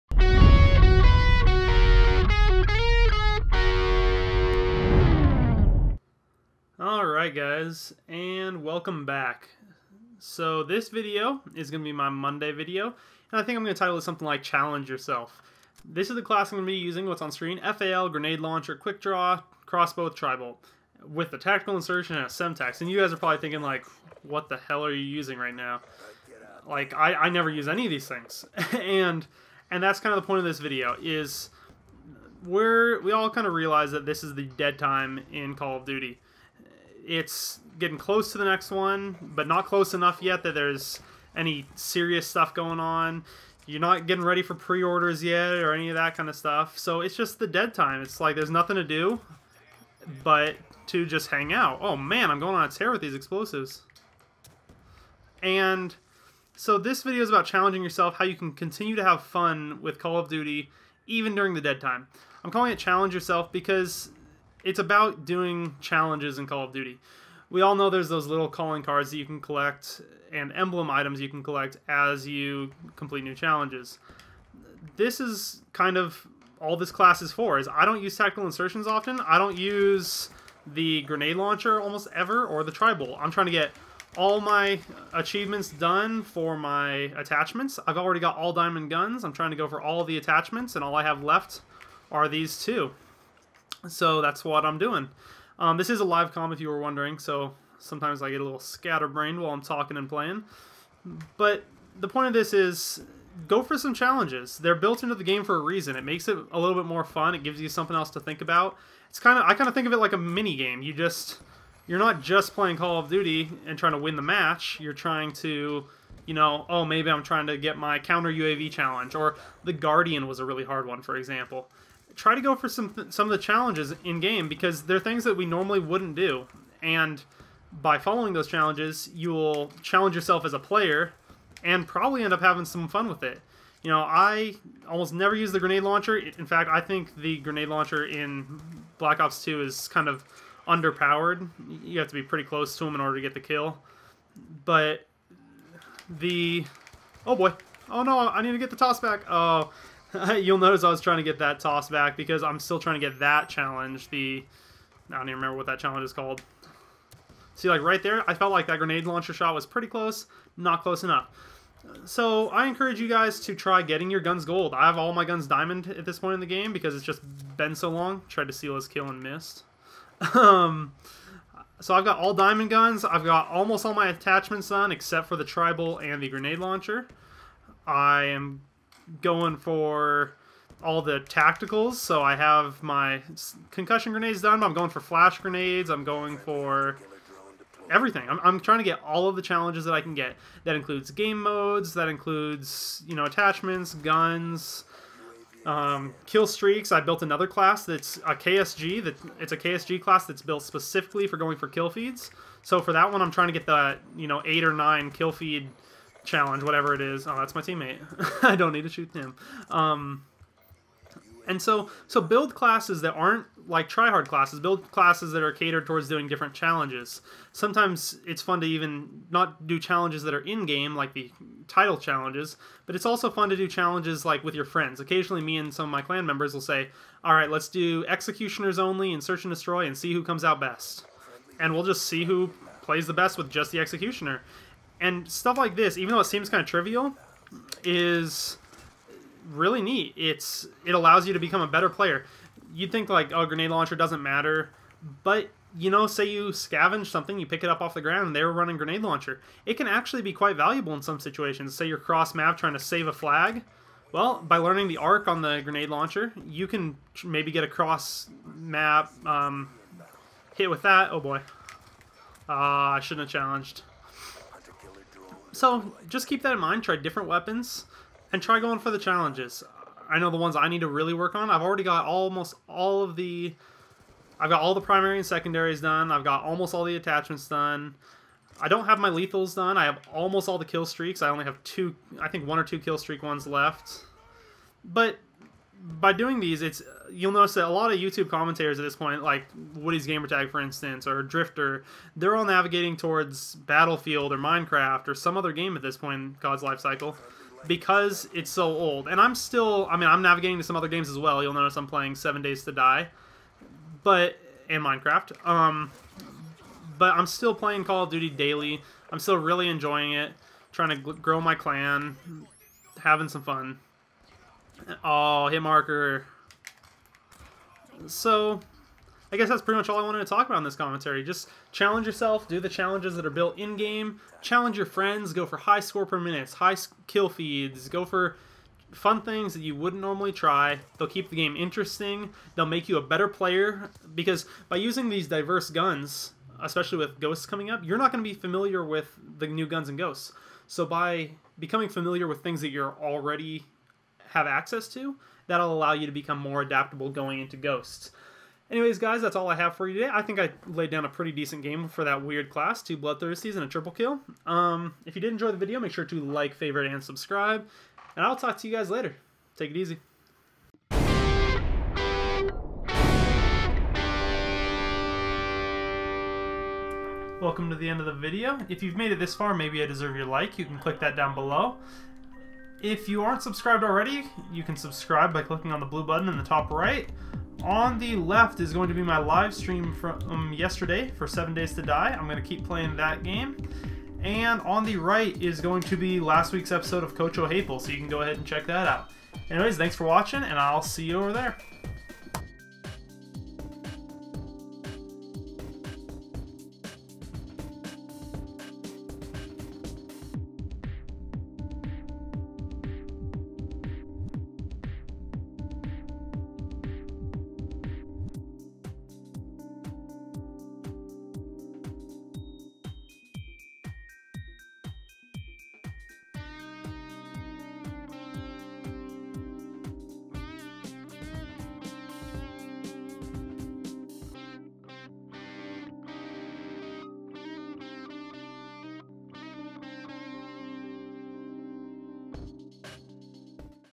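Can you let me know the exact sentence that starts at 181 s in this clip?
So I have my concussion grenades done.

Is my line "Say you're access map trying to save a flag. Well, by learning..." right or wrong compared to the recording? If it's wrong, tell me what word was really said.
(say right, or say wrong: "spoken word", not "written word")
wrong: "cross", not "access".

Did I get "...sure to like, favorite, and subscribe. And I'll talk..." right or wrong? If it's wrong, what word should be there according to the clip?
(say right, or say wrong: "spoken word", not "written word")
right.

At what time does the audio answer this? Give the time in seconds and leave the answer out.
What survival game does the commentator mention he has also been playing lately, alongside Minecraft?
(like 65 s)
302 s.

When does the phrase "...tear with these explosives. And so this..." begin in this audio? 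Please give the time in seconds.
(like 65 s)
52 s.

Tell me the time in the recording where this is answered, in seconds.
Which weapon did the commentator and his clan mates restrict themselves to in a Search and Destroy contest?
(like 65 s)
228 s.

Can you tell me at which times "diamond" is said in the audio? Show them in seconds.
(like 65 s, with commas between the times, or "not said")
88 s, 165 s, 172 s.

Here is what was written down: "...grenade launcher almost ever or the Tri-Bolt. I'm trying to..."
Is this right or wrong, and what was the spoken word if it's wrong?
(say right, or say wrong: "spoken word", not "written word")
right.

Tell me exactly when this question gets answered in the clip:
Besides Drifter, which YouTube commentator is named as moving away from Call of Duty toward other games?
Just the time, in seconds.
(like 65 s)
289 s.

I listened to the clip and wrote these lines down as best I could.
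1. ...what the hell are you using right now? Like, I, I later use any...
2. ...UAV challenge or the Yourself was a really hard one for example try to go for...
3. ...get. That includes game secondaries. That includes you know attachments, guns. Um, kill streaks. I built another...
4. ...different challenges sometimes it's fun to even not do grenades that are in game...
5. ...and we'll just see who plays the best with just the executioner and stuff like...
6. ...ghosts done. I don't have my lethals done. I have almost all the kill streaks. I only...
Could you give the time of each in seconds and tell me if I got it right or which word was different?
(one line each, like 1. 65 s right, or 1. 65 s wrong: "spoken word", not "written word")
1. 24 s wrong: "never", not "later"
2. 118 s wrong: "Guardian", not "Yourself"
3. 190 s wrong: "modes", not "secondaries"
4. 216 s wrong: "challenges", not "grenades"
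5. 231 s right
6. 276 s wrong: "attachments", not "ghosts".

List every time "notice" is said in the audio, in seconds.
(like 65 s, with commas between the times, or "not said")
150 s, 287 s, 301 s.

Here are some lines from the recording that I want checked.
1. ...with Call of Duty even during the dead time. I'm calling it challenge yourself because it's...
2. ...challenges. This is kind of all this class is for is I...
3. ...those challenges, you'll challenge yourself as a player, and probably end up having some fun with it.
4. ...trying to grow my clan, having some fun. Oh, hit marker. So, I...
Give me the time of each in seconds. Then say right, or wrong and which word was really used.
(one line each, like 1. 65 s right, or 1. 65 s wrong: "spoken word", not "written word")
1. 59 s right
2. 73 s right
3. 128 s right
4. 310 s right.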